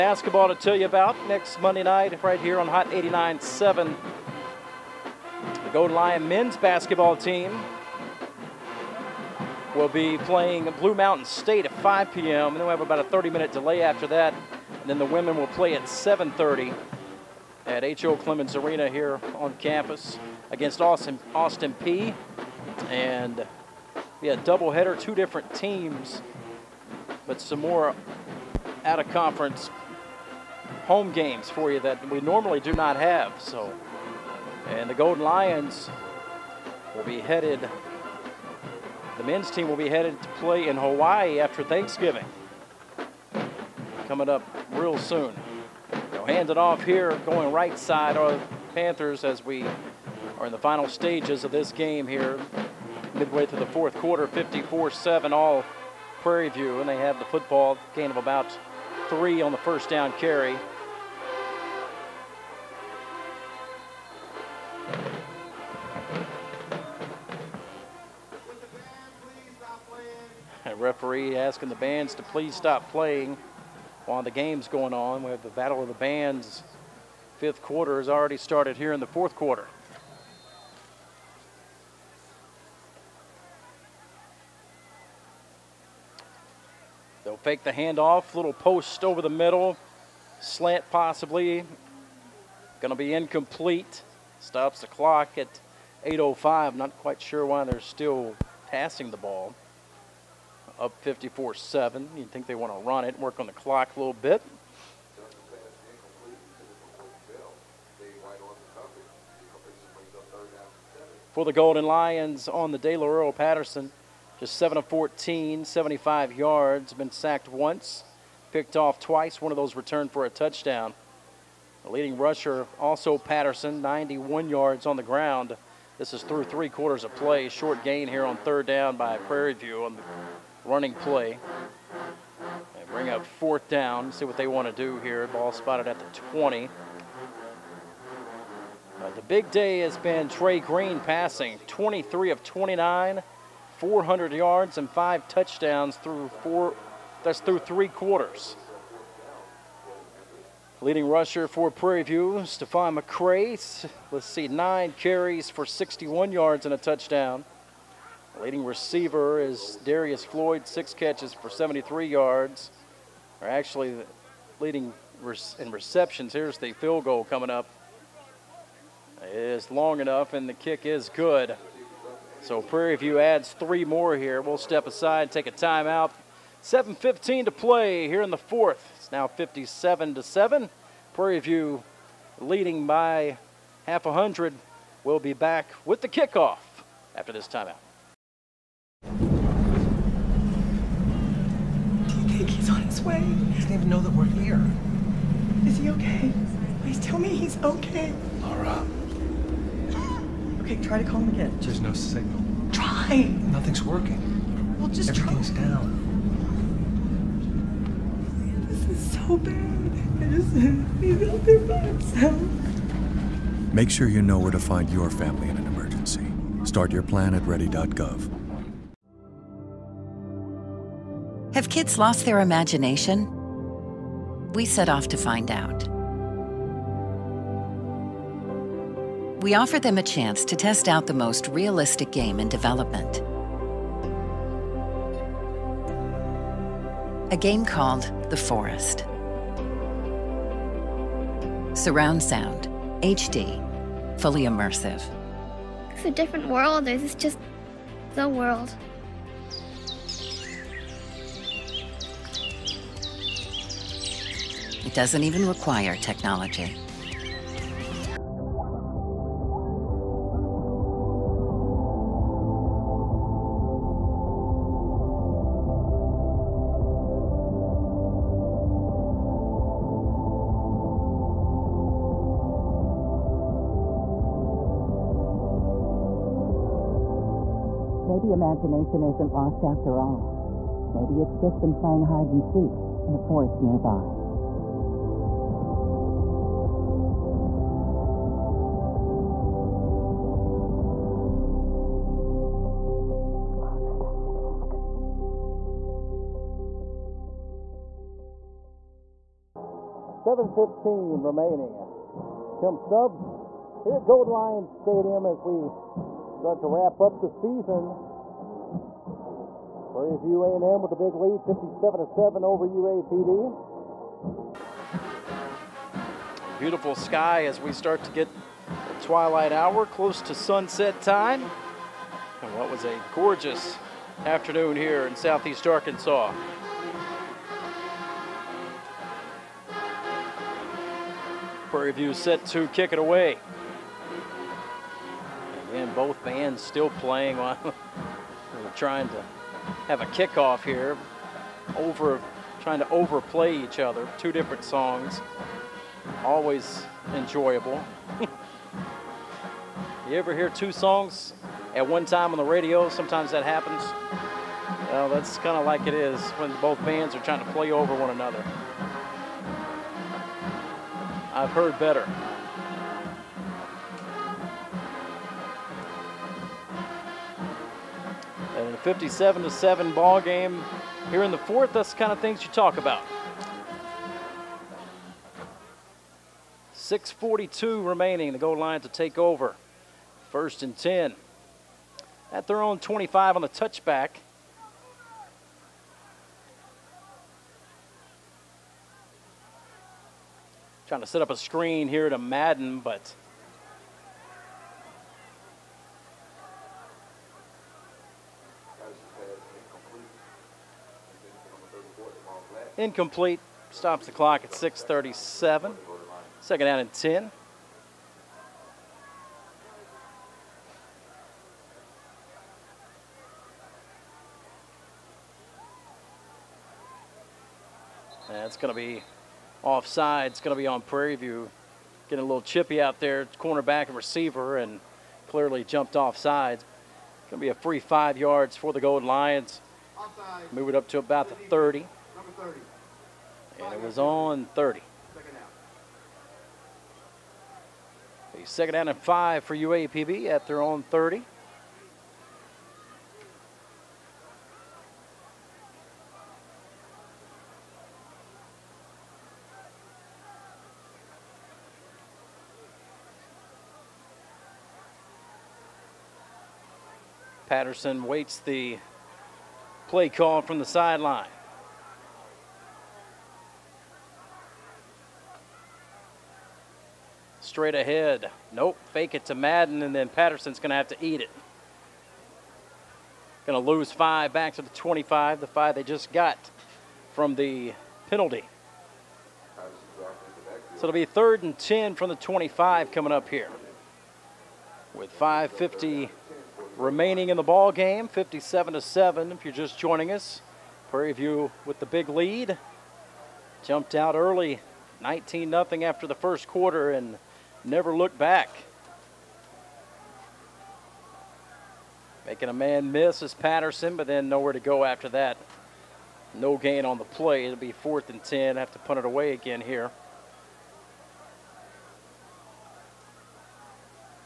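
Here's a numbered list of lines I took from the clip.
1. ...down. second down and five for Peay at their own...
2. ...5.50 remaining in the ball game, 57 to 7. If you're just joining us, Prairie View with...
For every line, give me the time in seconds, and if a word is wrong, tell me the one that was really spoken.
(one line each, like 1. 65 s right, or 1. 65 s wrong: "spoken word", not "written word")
1. 438 s wrong: "UAPB", not "Peay"
2. 485 s right.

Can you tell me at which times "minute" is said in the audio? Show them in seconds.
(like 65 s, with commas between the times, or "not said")
13 s.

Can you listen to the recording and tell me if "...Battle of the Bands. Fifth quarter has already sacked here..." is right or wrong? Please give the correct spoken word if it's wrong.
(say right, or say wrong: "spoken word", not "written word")
wrong: "started", not "sacked".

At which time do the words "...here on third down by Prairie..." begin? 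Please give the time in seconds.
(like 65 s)
128 s.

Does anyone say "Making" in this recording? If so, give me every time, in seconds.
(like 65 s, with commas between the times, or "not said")
502 s.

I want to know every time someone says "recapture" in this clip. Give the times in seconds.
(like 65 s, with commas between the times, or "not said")
not said.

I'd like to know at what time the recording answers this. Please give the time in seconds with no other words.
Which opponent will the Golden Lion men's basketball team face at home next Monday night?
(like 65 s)
10 s.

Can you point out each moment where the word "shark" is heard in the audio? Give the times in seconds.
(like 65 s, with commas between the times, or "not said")
not said.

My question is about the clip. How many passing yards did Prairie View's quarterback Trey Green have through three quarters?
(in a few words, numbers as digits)
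400.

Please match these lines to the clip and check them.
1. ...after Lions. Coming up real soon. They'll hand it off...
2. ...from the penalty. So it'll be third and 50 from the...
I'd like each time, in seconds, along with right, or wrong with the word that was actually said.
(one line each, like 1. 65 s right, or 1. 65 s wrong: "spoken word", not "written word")
1. 41 s wrong: "Thanksgiving", not "Lions"
2. 477 s wrong: "10", not "50".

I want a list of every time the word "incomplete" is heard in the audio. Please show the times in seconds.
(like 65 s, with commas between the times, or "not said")
93 s, 402 s.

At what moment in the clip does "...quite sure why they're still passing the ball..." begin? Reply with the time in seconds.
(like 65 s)
96 s.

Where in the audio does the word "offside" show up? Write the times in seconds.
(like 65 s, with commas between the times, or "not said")
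419 s, 425 s, 429 s.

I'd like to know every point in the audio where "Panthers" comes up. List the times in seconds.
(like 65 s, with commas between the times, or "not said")
48 s.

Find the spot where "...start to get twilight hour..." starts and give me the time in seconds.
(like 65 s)
317 s.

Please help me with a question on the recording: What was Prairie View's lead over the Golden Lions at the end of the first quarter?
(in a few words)
19-0.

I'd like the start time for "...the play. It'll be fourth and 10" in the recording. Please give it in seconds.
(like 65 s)
506 s.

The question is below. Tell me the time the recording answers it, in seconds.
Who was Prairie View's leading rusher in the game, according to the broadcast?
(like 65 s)
152 s.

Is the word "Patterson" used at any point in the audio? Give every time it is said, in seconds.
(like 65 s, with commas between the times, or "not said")
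113 s, 123 s, 457 s, 470 s, 503 s.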